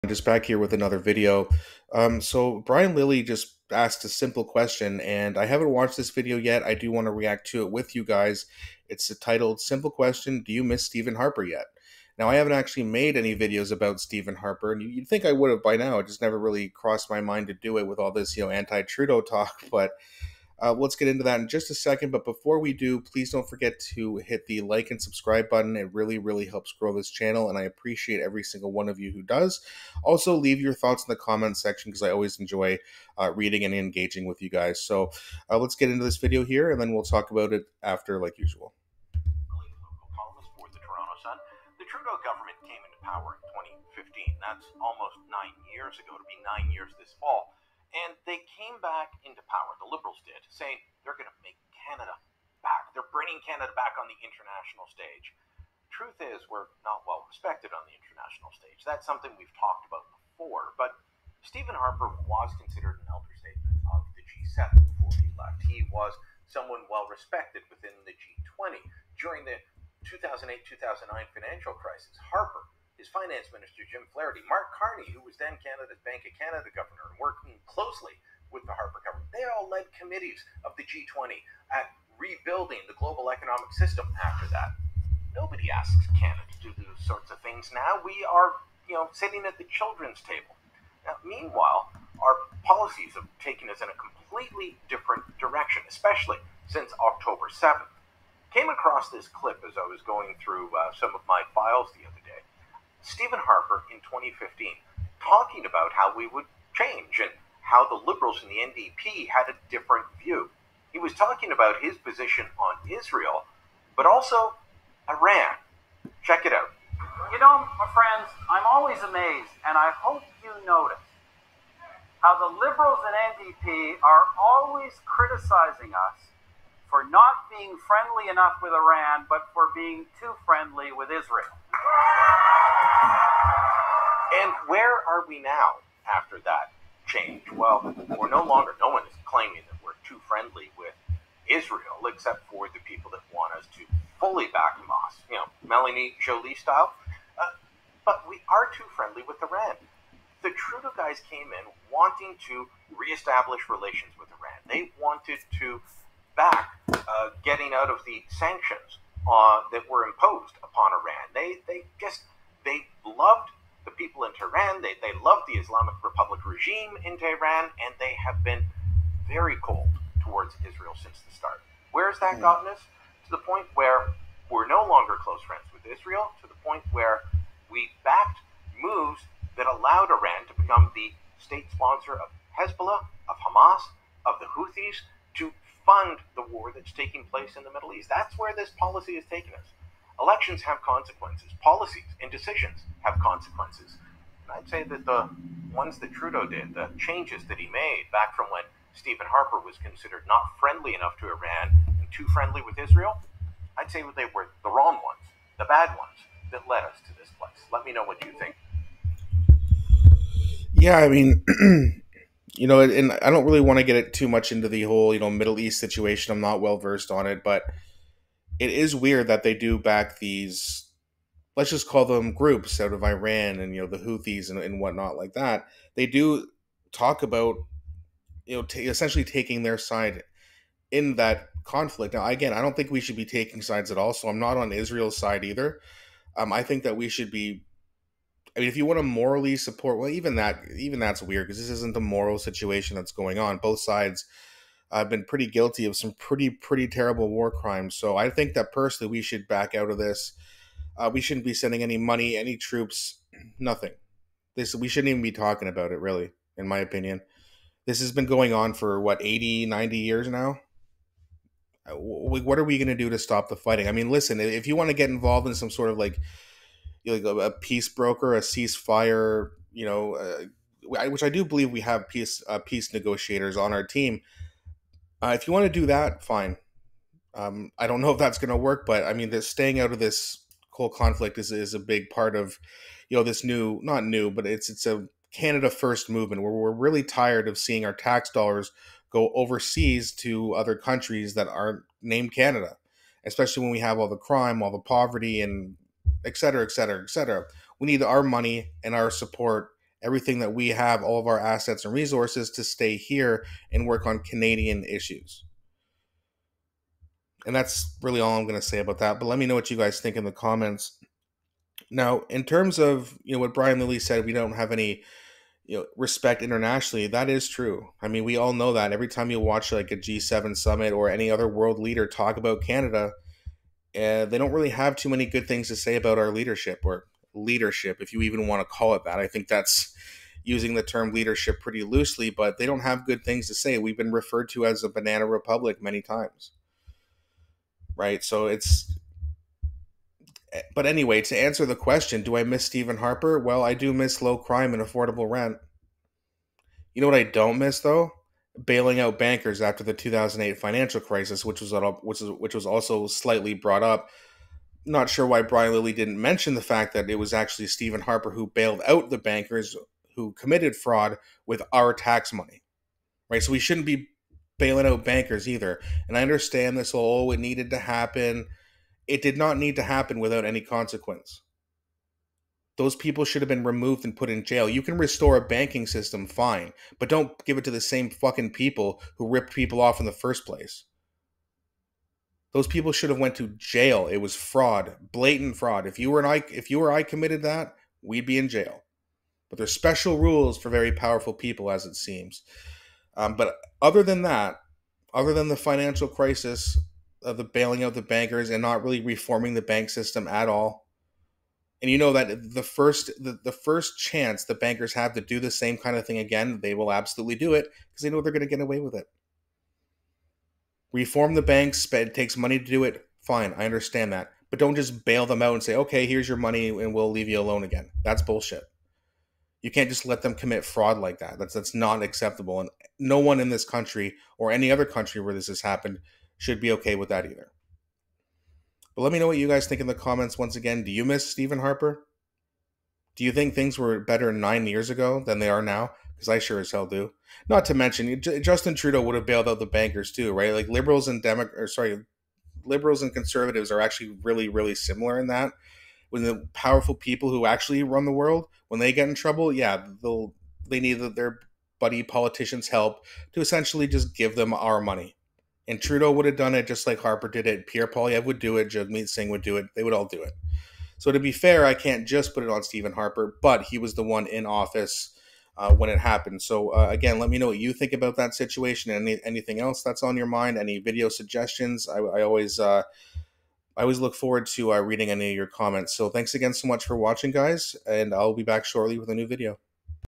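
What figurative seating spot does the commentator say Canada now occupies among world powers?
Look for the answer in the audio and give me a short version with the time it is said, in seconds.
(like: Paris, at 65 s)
The children's table, at 89 s.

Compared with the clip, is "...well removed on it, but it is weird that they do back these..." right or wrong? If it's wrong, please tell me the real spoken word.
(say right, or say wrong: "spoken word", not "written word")
wrong: "versed", not "removed".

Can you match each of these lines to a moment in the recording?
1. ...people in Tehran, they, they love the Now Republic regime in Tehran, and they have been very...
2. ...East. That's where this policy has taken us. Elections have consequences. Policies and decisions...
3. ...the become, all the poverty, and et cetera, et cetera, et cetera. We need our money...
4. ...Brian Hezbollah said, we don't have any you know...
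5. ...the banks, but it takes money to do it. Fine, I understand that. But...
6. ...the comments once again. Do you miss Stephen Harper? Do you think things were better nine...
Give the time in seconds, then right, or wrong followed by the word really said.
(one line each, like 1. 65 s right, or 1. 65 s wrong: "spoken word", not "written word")
1. 163 s wrong: "Islamic", not "Now"
2. 187 s right
3. 294 s wrong: "crime", not "become"
4. 313 s wrong: "Lilley", not "Hezbollah"
5. 411 s right
6. 429 s right.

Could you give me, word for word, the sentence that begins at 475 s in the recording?
So thanks again so much for watching, guys, and I'll be back shortly with a new video.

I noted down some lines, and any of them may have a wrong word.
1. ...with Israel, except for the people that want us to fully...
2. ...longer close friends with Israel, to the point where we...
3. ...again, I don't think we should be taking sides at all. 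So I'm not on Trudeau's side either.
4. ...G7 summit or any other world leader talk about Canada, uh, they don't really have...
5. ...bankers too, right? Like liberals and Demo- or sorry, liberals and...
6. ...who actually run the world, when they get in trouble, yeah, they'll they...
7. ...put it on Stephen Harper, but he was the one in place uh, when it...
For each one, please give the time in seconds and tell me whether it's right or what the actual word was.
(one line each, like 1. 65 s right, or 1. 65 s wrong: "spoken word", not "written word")
1. 140 s right
2. 174 s right
3. 232 s wrong: "Israel", not "Trudeau"
4. 319 s right
5. 439 s right
6. 447 s right
7. 462 s wrong: "office", not "place".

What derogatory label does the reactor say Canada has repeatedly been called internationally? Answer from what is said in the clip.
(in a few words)
Banana republic.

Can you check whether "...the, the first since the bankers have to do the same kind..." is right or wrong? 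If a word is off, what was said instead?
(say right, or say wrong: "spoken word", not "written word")
wrong: "chance", not "since".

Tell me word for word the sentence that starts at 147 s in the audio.
Uh, but we are too friendly with Iran.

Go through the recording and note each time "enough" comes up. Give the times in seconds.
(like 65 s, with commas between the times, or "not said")
128 s, 200 s.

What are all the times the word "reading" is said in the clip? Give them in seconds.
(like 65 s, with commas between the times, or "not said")
33 s, 474 s.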